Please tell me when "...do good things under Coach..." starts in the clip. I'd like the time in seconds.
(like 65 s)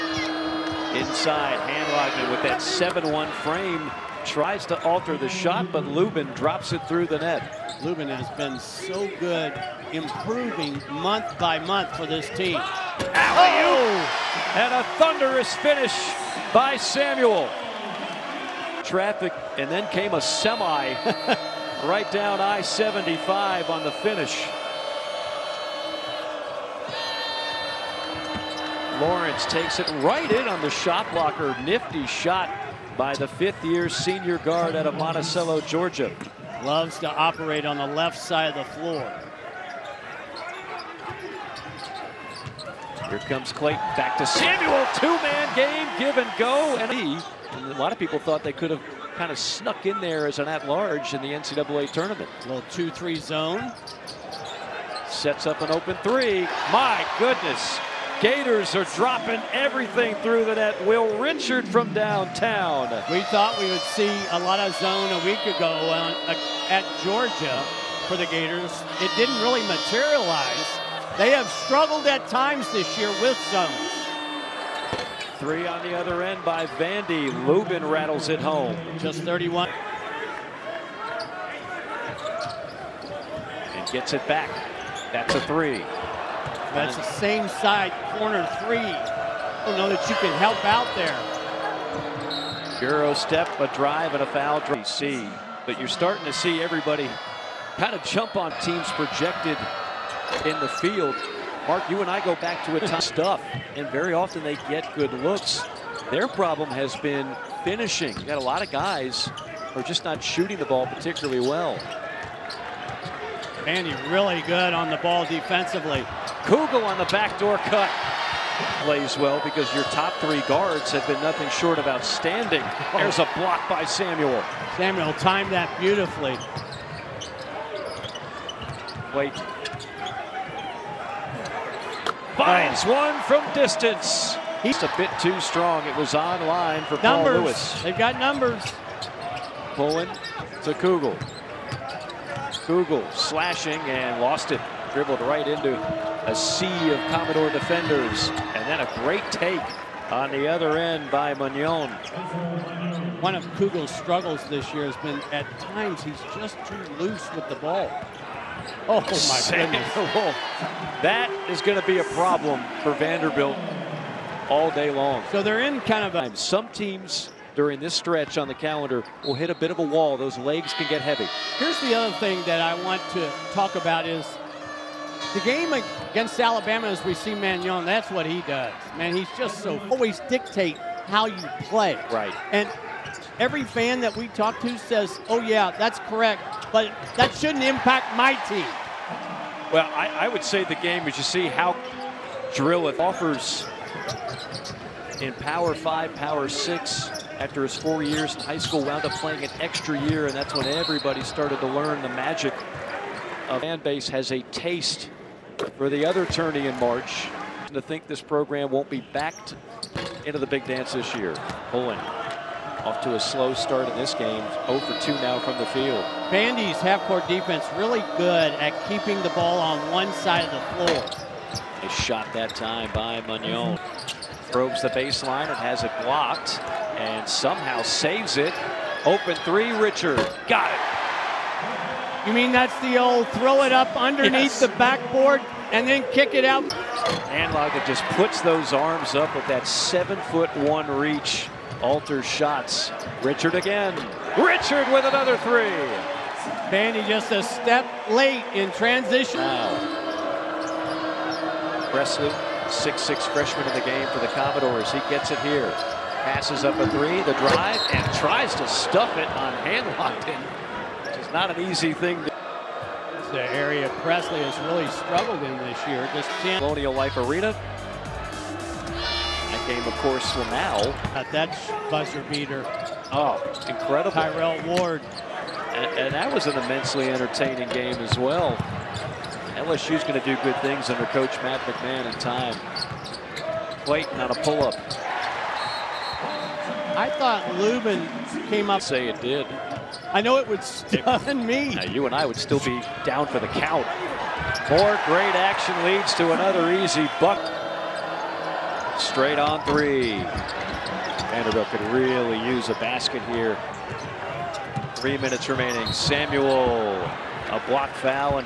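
280 s.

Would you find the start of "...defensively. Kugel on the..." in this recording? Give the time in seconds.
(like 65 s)
115 s.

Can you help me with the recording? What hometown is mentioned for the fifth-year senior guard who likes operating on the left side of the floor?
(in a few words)
Monticello, Georgia.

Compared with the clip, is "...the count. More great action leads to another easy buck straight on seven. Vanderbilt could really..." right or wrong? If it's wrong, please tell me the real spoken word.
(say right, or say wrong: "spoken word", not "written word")
wrong: "three", not "seven".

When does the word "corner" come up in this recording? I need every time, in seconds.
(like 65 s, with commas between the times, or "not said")
88 s.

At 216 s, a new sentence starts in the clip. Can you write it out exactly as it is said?
Vandy's half-court defense really good at keeping the ball on one side of the floor.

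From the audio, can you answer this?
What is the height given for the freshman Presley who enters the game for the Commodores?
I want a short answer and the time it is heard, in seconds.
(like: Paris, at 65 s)
6'6, at 252 s.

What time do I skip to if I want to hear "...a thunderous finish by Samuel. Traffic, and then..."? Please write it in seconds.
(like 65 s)
14 s.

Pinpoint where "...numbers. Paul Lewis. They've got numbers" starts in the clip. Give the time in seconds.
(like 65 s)
137 s.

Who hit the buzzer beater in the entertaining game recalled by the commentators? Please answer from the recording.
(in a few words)
Tyrell Ward.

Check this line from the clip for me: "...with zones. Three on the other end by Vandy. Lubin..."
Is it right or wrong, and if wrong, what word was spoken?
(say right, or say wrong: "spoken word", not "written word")
right.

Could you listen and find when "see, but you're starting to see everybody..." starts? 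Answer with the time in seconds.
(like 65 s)
94 s.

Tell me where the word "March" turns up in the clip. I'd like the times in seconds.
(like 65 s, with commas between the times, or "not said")
206 s.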